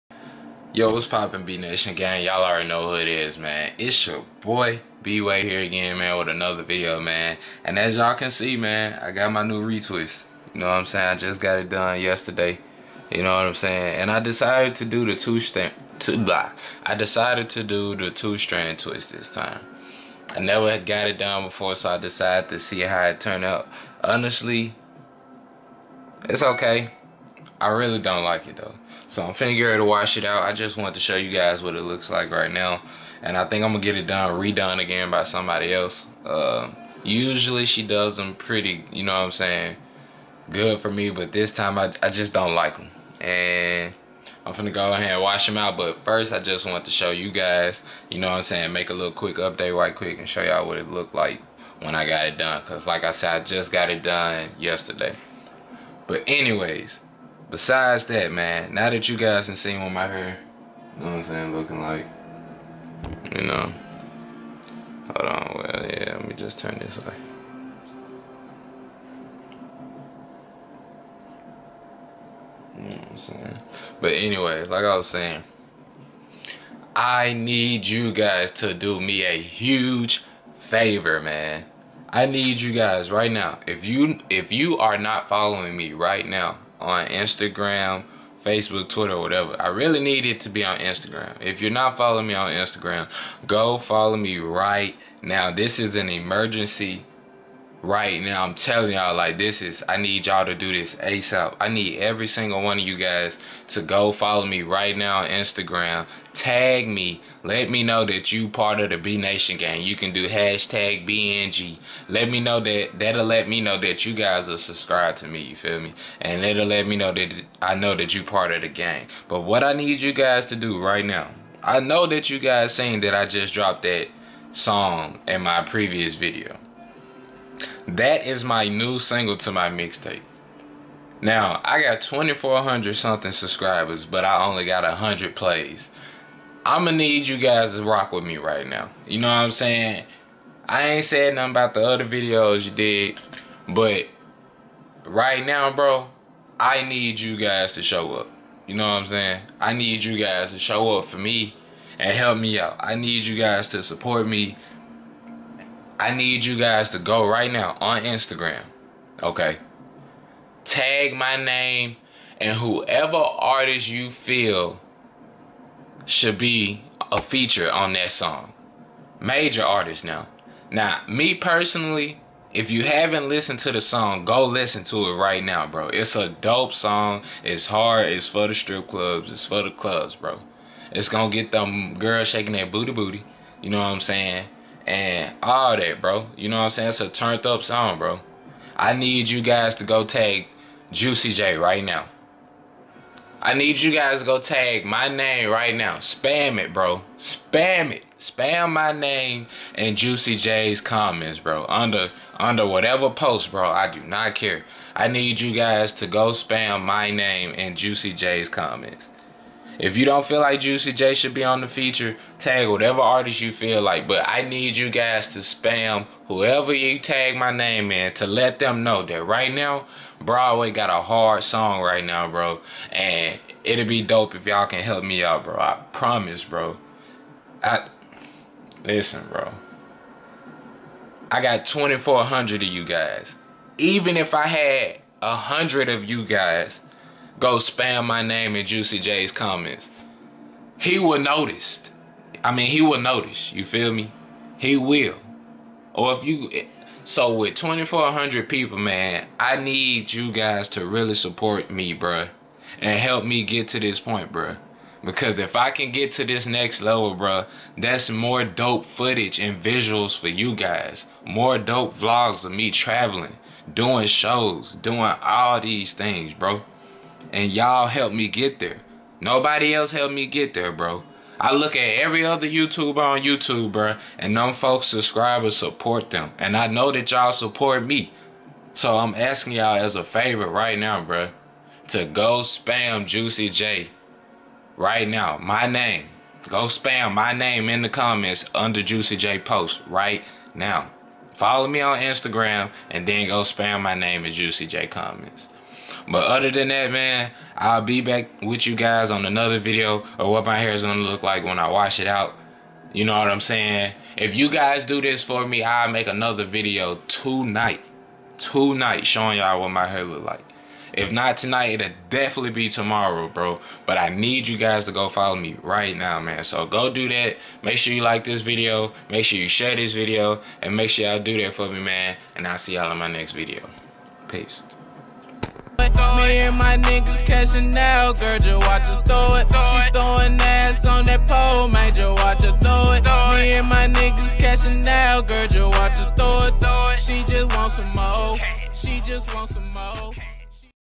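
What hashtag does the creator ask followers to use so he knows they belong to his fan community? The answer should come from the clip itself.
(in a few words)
#BNG.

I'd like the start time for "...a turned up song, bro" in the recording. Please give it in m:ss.
3:07.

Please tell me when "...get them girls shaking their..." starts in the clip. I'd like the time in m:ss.
3:01.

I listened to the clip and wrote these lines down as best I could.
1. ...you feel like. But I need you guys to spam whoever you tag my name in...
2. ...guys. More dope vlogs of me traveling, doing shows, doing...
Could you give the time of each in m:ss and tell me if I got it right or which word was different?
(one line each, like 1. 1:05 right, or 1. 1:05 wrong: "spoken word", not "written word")
1. 3:33 right
2. 4:20 right.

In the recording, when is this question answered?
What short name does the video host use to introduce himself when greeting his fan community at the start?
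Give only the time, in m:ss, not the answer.
0:05.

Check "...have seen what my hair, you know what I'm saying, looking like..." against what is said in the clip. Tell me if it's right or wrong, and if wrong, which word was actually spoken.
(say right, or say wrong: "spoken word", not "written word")
right.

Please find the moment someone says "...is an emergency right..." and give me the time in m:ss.
1:35.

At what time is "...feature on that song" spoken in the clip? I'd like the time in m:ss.
2:47.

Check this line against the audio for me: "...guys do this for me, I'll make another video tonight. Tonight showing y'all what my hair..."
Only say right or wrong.
right.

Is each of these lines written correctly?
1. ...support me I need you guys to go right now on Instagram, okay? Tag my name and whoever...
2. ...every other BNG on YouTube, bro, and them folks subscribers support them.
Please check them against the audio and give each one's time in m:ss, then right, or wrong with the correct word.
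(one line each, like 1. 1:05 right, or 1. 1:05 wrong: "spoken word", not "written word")
1. 2:33 right
2. 4:31 wrong: "YouTuber", not "BNG".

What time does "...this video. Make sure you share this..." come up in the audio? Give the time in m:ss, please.
5:18.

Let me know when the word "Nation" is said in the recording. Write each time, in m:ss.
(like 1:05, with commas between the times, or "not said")
0:01, 1:49.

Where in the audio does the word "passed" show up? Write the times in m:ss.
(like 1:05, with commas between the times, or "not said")
not said.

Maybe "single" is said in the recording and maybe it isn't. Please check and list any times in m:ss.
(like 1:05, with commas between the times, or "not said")
1:42, 2:08.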